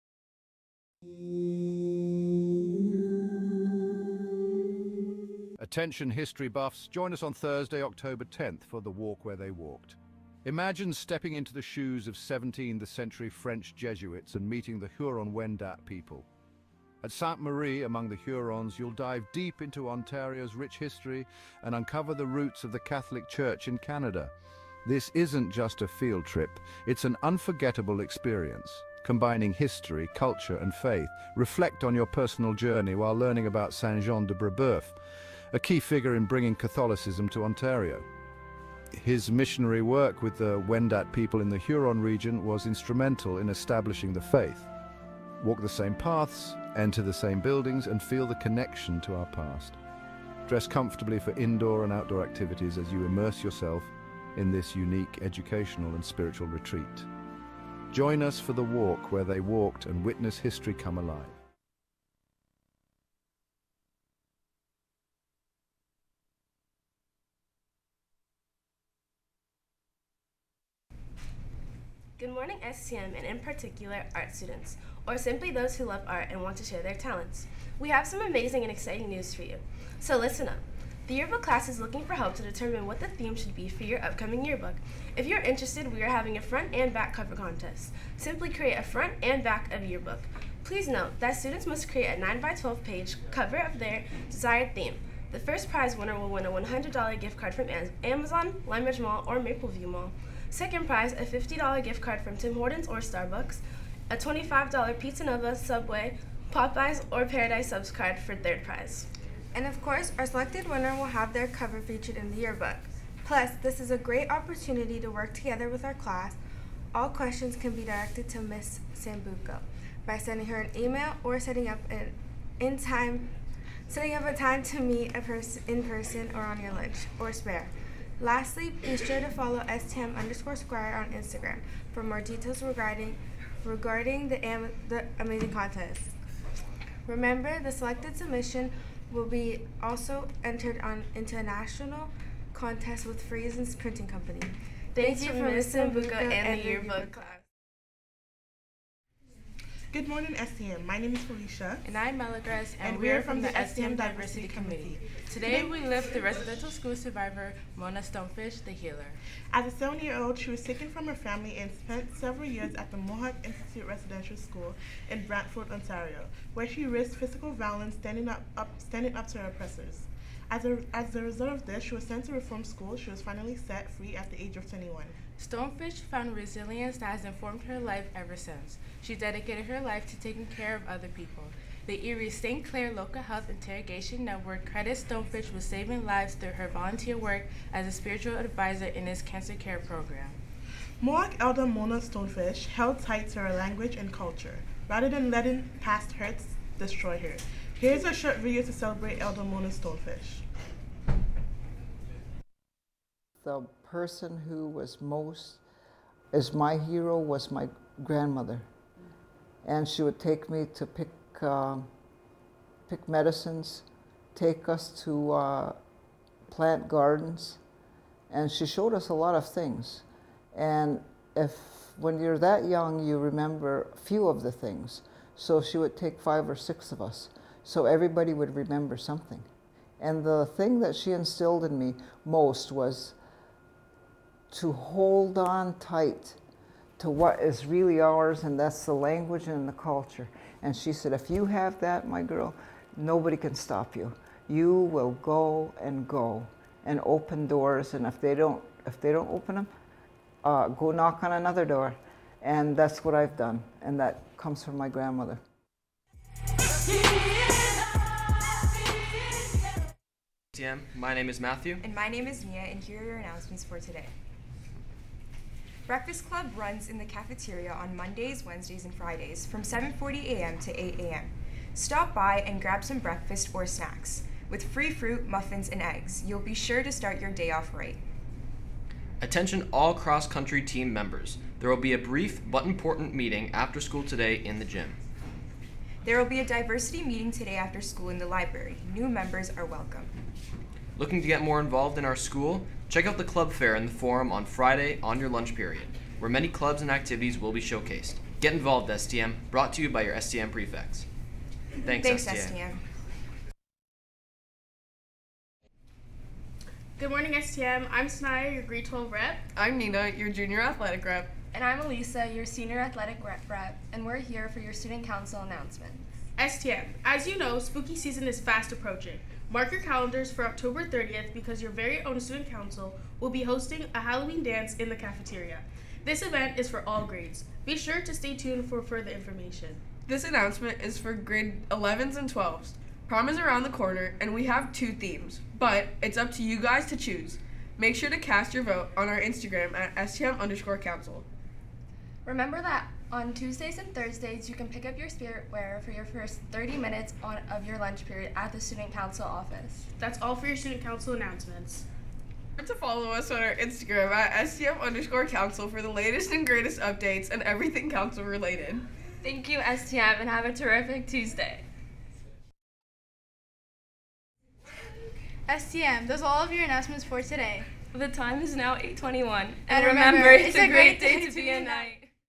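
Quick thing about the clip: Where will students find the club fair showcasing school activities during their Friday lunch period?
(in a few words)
The forum.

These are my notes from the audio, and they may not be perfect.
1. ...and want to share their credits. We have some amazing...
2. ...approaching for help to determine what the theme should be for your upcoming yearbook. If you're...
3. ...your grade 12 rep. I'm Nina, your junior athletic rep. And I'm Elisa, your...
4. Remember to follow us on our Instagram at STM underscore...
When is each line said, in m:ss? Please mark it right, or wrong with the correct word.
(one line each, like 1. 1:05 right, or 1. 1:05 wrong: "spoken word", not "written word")
1. 1:16 wrong: "talents", not "credits"
2. 1:21 wrong: "looking", not "approaching"
3. 5:08 right
4. 5:52 right.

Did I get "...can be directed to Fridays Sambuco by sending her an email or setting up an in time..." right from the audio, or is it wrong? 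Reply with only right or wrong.
wrong.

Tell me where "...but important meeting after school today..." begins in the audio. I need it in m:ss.
4:42.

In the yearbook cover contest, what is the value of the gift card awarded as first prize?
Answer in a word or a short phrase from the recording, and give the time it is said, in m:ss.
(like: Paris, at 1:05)
$100, at 1:36.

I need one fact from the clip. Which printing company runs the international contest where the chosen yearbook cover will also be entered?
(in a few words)
Friesen's Printing Company.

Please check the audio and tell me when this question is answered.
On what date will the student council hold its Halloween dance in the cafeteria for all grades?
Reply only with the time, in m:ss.
5:20.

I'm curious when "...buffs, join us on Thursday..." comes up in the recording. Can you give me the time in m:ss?
0:06.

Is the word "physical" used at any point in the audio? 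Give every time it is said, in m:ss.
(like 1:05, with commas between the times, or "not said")
2:47.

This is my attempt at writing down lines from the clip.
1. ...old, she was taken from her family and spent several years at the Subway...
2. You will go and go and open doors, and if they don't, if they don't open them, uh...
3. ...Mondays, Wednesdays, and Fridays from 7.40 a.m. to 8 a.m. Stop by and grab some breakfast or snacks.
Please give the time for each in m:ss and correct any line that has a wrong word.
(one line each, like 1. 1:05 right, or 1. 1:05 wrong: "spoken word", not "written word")
1. 2:40 wrong: "Mohawk", not "Subway"
2. 4:04 right
3. 4:27 right.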